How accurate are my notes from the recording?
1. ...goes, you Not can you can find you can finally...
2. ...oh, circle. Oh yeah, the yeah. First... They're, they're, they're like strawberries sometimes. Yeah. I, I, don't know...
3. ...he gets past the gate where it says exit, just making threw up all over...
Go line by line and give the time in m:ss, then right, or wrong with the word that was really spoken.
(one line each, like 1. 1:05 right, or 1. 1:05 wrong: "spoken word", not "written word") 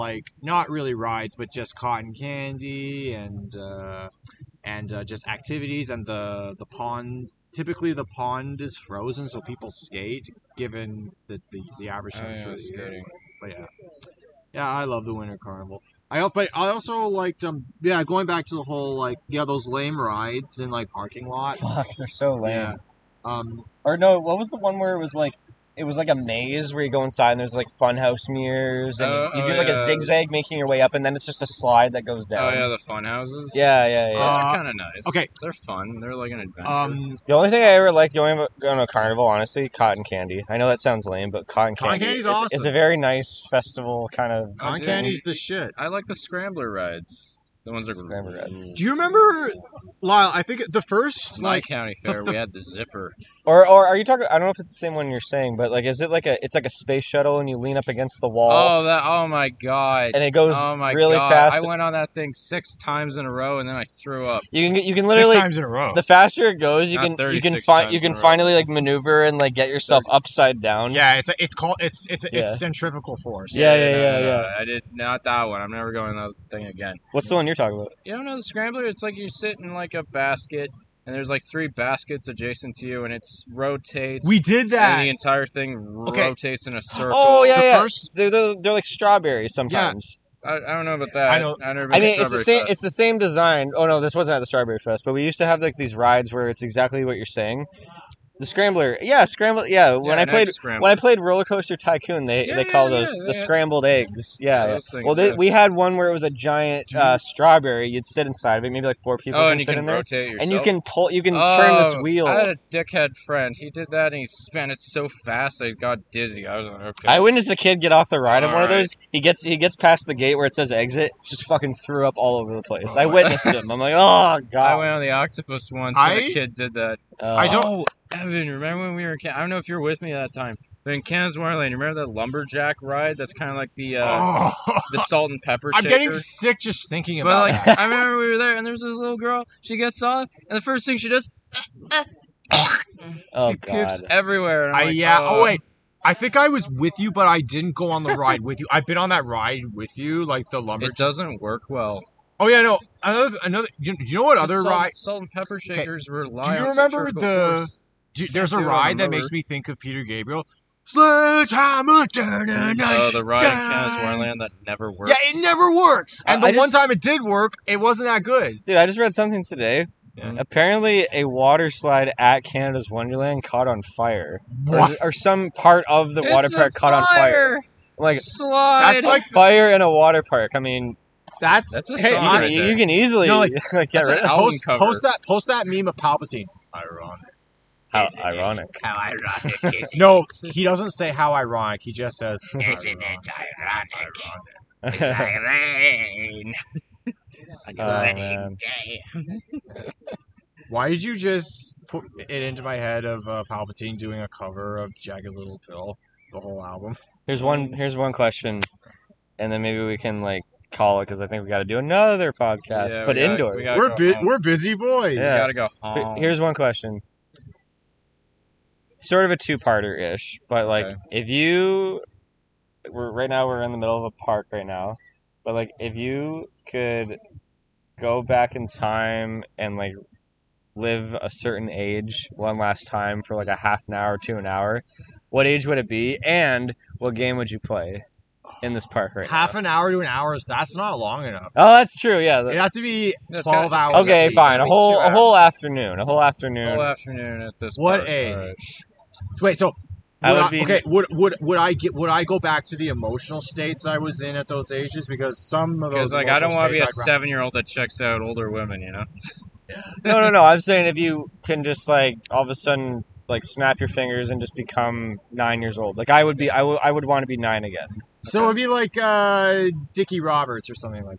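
1. 1:06 right
2. 1:26 right
3. 1:59 wrong: "fucking", not "making".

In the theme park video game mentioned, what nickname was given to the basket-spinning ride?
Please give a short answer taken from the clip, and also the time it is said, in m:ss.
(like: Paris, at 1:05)
the scrambled eggs, at 1:43.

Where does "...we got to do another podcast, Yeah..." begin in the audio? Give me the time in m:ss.
3:31.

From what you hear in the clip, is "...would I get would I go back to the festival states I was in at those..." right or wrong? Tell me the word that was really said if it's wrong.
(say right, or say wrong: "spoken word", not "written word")
wrong: "emotional", not "festival".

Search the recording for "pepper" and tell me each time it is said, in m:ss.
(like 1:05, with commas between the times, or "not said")
2:15, 2:35.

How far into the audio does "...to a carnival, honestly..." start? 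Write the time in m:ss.
0:38.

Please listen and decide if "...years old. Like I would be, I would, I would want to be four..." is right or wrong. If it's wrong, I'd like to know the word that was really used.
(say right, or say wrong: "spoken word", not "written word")
wrong: "nine", not "four".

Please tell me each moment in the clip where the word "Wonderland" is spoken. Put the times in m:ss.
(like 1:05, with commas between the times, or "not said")
2:11, 2:44, 2:52.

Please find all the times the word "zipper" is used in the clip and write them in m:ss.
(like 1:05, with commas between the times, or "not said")
0:52.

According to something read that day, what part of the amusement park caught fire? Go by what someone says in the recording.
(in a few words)
a water slide.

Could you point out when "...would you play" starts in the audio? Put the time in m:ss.
3:57.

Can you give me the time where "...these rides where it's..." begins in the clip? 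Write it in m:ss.
1:35.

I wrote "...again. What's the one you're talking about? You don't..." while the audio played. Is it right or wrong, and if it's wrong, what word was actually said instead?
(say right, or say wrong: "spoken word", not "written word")
right.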